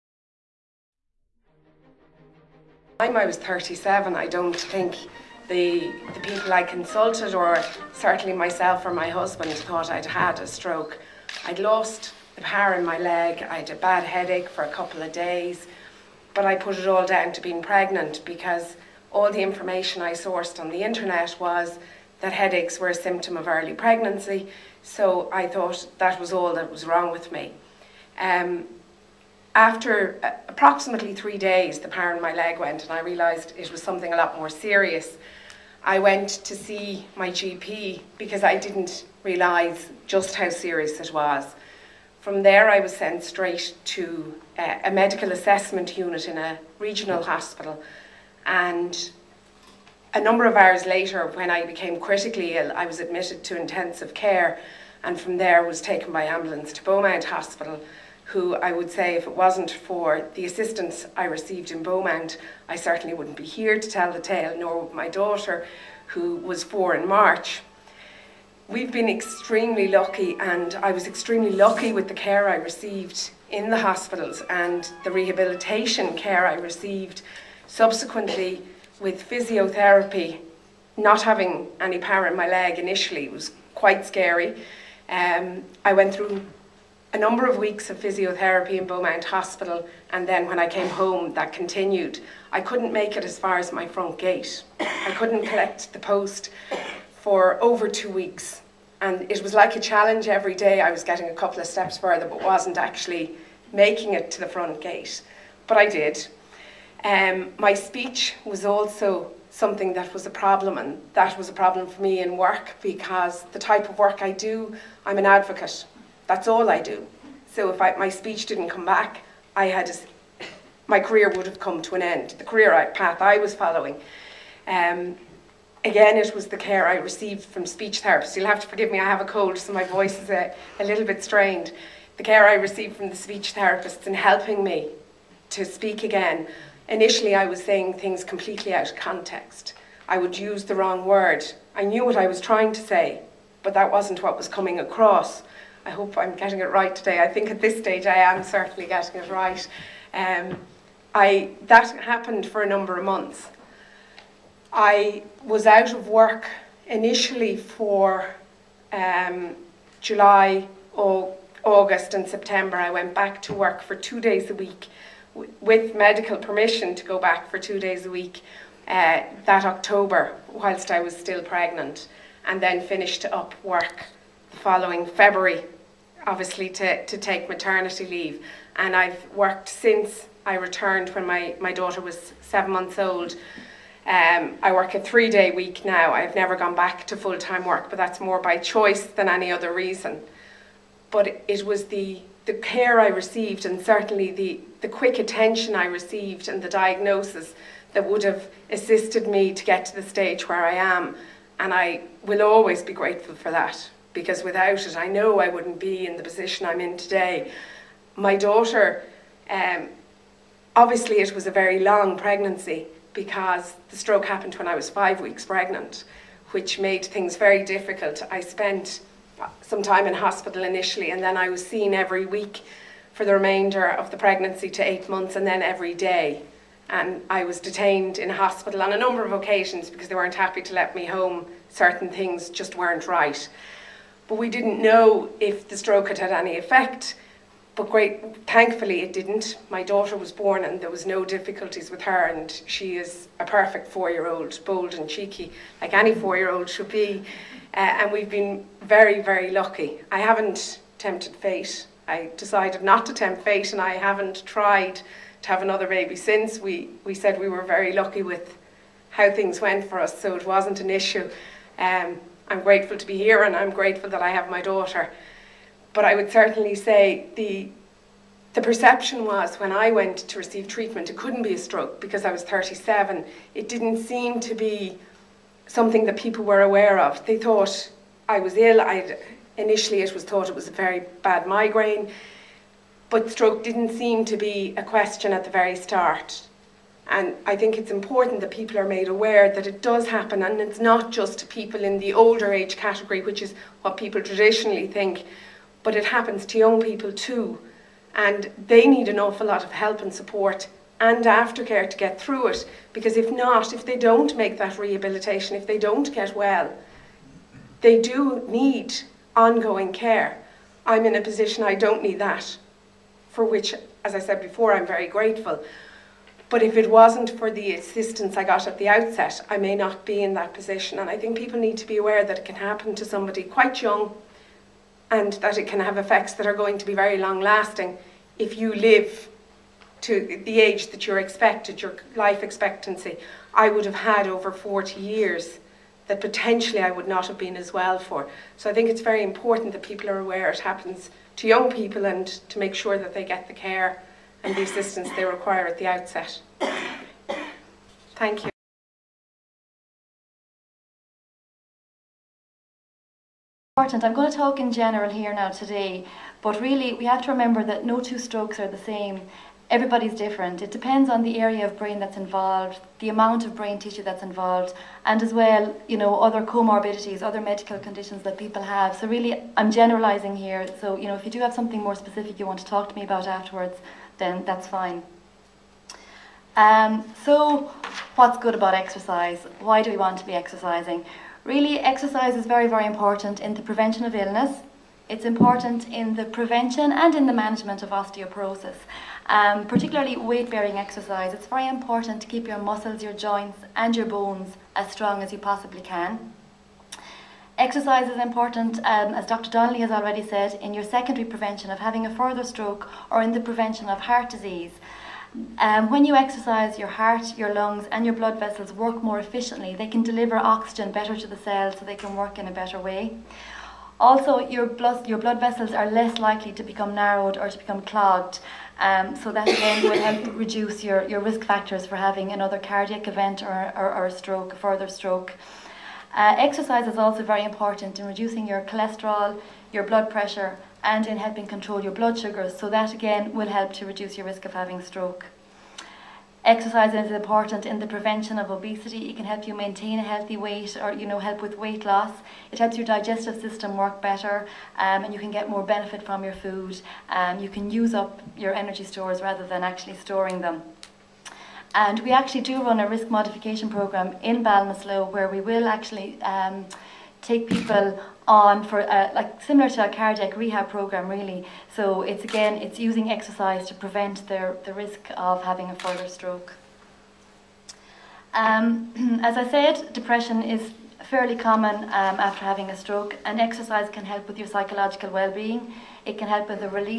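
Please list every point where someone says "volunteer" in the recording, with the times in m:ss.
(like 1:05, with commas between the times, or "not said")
not said.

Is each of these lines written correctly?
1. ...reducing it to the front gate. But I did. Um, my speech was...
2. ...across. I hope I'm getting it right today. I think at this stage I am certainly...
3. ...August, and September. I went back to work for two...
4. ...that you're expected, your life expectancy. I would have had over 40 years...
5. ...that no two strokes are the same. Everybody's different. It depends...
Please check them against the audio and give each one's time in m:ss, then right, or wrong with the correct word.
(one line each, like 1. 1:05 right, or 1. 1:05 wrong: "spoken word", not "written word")
1. 1:43 wrong: "making", not "reducing"
2. 2:24 right
3. 2:41 right
4. 5:30 right
5. 5:57 right.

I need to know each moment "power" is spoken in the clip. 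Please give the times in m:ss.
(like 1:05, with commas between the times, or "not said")
0:12, 0:31, 1:21.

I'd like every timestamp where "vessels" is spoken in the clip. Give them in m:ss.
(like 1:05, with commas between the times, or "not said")
6:48, 6:55.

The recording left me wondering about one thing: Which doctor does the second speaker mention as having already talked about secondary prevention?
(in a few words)
Dr. Donnelly.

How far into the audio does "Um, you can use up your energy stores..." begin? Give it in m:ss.
7:27.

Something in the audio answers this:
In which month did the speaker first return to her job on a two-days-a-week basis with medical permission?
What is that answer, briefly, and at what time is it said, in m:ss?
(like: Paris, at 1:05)
October, at 2:49.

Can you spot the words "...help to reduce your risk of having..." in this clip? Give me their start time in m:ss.
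7:13.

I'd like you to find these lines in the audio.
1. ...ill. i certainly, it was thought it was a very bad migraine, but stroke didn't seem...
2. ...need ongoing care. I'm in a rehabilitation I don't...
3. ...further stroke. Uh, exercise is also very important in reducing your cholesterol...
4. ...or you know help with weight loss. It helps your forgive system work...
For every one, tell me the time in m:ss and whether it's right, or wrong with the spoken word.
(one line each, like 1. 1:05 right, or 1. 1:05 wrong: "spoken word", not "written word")
1. 4:38 wrong: "initially", not "certainly"
2. 5:08 wrong: "position", not "rehabilitation"
3. 7:04 right
4. 7:20 wrong: "digestive", not "forgive".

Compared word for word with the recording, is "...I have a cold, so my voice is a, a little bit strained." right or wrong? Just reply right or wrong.
right.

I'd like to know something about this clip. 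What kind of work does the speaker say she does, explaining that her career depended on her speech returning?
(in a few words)
advocate.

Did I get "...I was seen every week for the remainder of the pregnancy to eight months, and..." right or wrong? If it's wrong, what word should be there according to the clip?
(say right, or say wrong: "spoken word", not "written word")
right.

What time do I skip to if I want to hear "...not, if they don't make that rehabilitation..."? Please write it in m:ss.
5:03.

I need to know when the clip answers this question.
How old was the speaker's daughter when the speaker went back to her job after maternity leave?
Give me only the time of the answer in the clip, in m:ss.
3:02.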